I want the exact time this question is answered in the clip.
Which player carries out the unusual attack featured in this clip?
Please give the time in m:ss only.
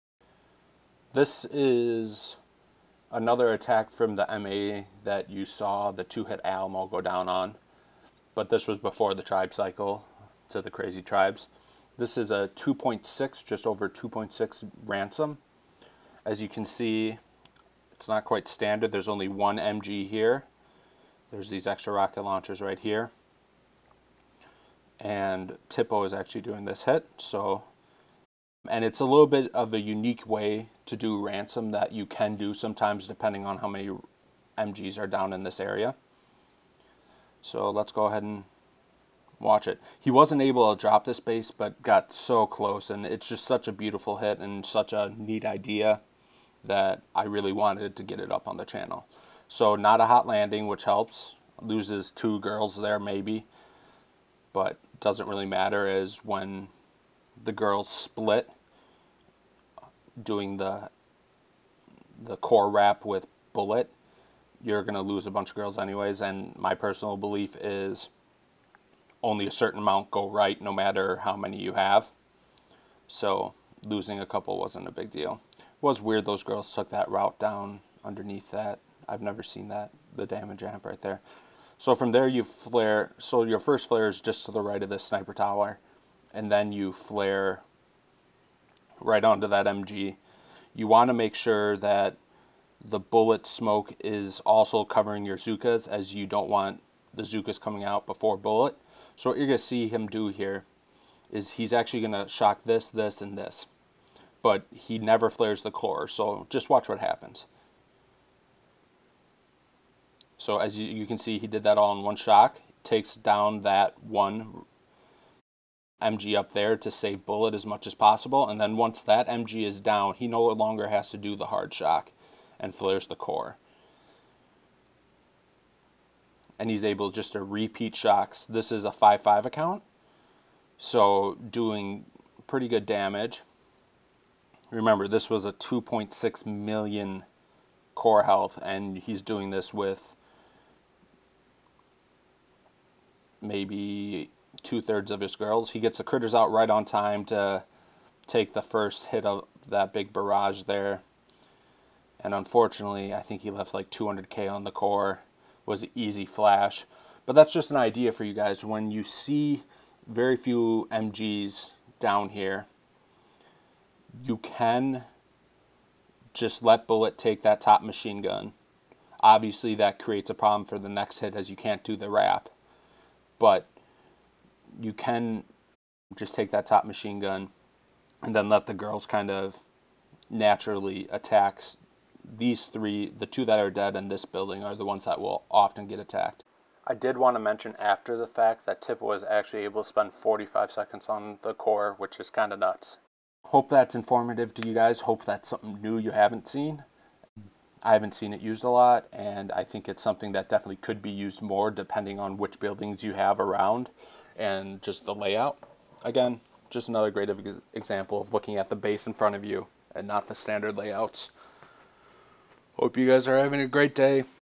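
0:25.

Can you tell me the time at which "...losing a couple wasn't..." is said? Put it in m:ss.
1:13.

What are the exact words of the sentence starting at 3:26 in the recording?
Again, just another great example of looking at the base in front of you and not the standard layouts.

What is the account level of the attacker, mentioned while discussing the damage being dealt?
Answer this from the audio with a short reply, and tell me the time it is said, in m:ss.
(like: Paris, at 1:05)
5-5, at 2:08.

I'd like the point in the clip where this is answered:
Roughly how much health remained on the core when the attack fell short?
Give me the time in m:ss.
2:33.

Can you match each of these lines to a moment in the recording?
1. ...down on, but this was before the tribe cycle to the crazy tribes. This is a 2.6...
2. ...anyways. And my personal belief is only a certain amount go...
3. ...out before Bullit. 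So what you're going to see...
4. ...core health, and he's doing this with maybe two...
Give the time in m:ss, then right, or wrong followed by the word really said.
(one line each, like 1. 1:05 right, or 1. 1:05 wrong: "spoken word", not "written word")
1. 0:07 right
2. 1:05 right
3. 1:37 right
4. 2:17 right.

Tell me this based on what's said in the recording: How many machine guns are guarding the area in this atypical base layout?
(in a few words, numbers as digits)
1.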